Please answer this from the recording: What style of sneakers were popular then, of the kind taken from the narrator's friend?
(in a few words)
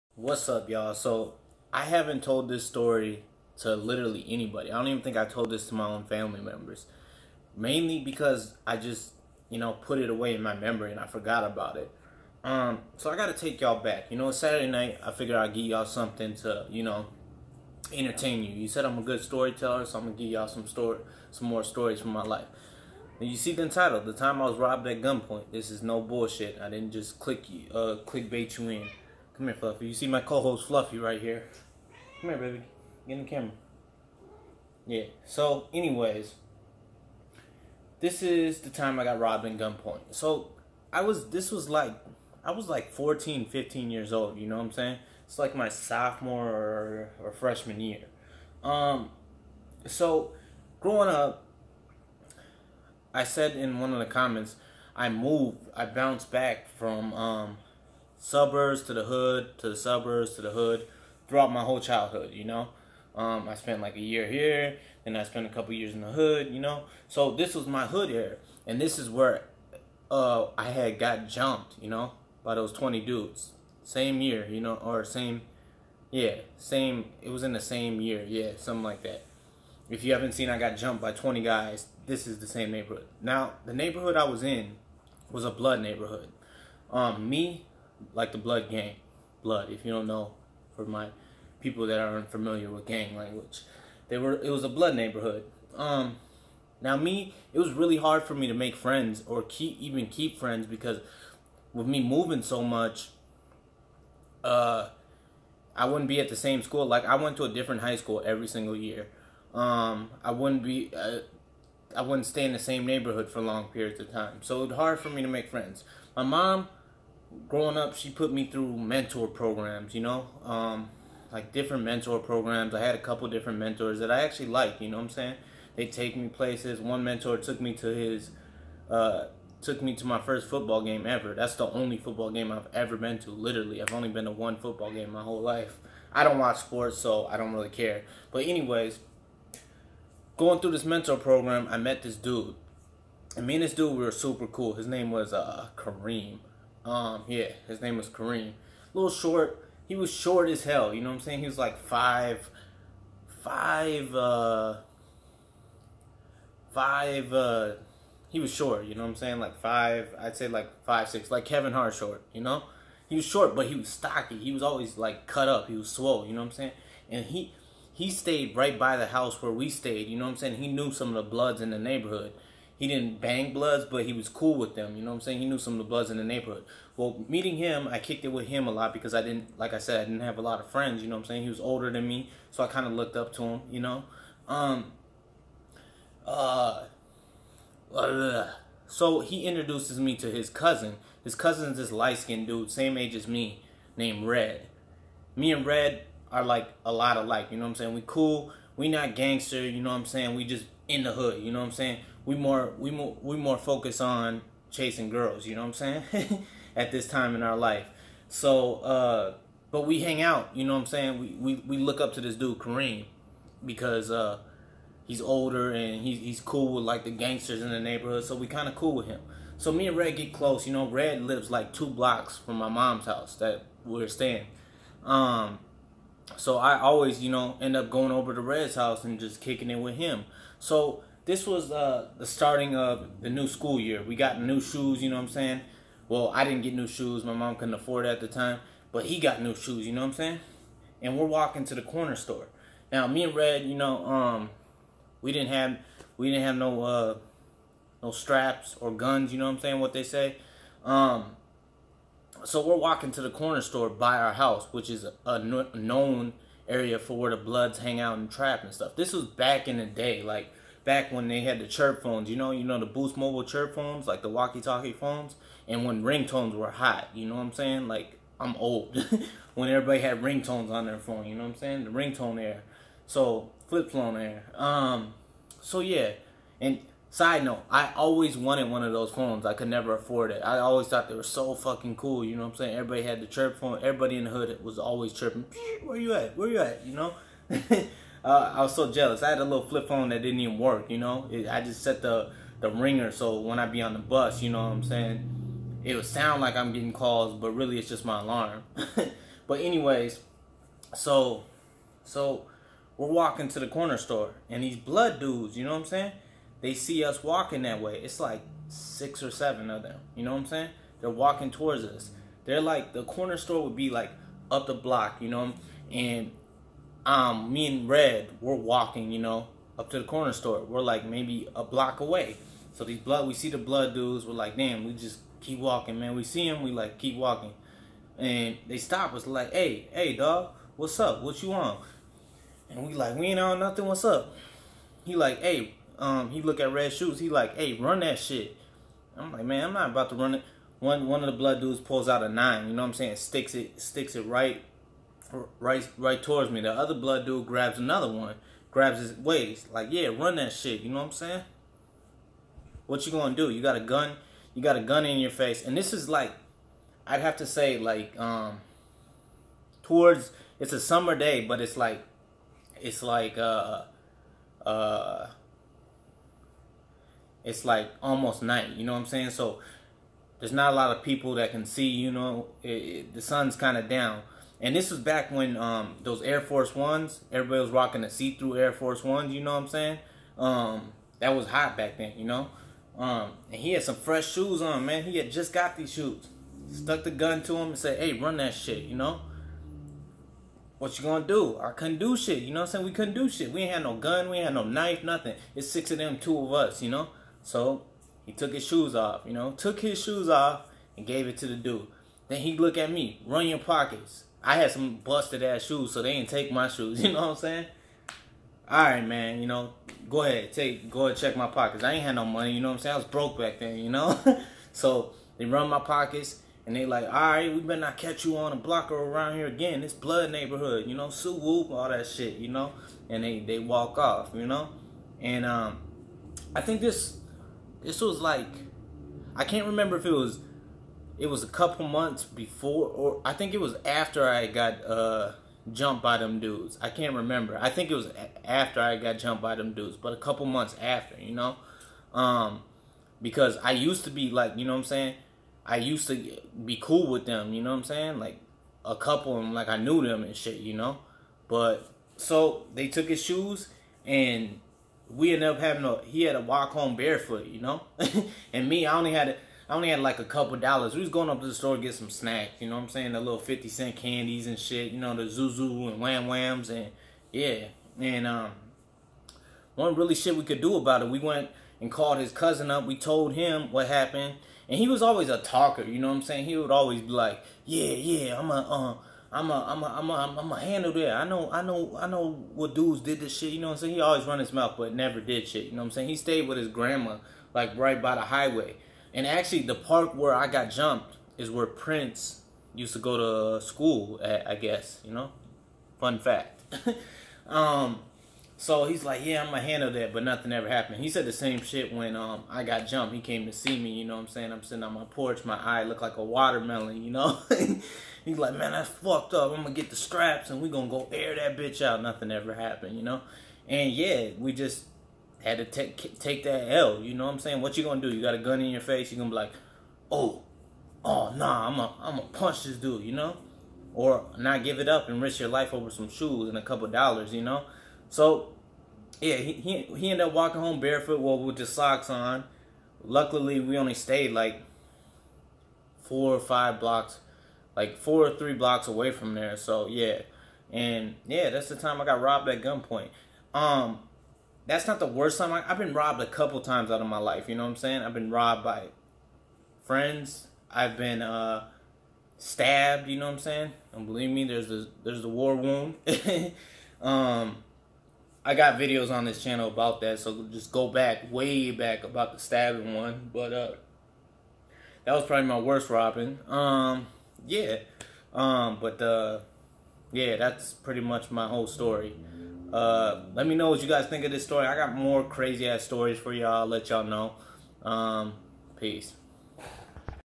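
See-through Air Force Ones.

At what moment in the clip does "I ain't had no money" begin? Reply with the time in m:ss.
6:51.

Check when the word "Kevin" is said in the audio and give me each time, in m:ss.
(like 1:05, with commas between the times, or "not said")
2:41.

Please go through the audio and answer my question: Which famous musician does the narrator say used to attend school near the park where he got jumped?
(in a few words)
Prince.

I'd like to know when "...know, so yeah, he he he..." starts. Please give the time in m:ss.
8:47.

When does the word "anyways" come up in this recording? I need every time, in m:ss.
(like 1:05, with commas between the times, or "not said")
0:35, 2:18, 4:59.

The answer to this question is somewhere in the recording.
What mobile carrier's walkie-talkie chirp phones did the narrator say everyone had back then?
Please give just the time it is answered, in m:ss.
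4:22.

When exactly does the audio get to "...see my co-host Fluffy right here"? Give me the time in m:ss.
0:29.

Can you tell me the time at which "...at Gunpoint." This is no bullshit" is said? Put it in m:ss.
0:24.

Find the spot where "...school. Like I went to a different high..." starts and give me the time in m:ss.
1:46.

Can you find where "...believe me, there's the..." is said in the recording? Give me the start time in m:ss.
9:14.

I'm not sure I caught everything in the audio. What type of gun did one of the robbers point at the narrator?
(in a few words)
A nine.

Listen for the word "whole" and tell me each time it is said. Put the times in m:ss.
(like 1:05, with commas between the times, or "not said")
1:01, 2:15, 9:31.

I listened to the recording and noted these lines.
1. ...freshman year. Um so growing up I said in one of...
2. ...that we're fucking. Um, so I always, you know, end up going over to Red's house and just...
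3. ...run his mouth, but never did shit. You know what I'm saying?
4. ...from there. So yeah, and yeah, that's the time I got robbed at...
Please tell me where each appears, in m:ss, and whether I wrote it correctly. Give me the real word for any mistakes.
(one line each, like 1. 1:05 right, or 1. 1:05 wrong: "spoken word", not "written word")
1. 0:47 right
2. 3:43 wrong: "staying", not "fucking"
3. 8:04 right
4. 8:59 right.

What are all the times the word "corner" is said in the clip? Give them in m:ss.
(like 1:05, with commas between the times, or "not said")
4:01, 4:13, 5:03, 5:13, 5:20.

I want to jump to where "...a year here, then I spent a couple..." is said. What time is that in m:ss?
1:03.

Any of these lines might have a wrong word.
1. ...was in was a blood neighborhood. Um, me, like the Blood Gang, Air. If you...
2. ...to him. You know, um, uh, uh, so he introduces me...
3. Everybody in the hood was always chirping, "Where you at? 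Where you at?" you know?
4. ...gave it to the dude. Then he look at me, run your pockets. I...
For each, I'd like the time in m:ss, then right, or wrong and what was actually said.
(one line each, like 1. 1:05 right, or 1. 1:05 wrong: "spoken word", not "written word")
1. 1:24 wrong: "Blood", not "Air"
2. 3:03 right
3. 4:43 right
4. 6:41 right.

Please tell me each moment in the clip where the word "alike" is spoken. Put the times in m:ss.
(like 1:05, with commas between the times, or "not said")
3:17.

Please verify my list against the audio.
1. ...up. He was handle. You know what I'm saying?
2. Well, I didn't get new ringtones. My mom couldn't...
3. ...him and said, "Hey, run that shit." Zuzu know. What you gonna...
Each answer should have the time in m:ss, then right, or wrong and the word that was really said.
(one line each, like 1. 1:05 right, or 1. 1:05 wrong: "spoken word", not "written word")
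1. 2:45 wrong: "swole", not "handle"
2. 3:56 wrong: "shoes", not "ringtones"
3. 6:27 wrong: "You", not "Zuzu".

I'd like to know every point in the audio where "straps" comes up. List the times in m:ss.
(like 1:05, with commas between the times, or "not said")
4:08, 8:29.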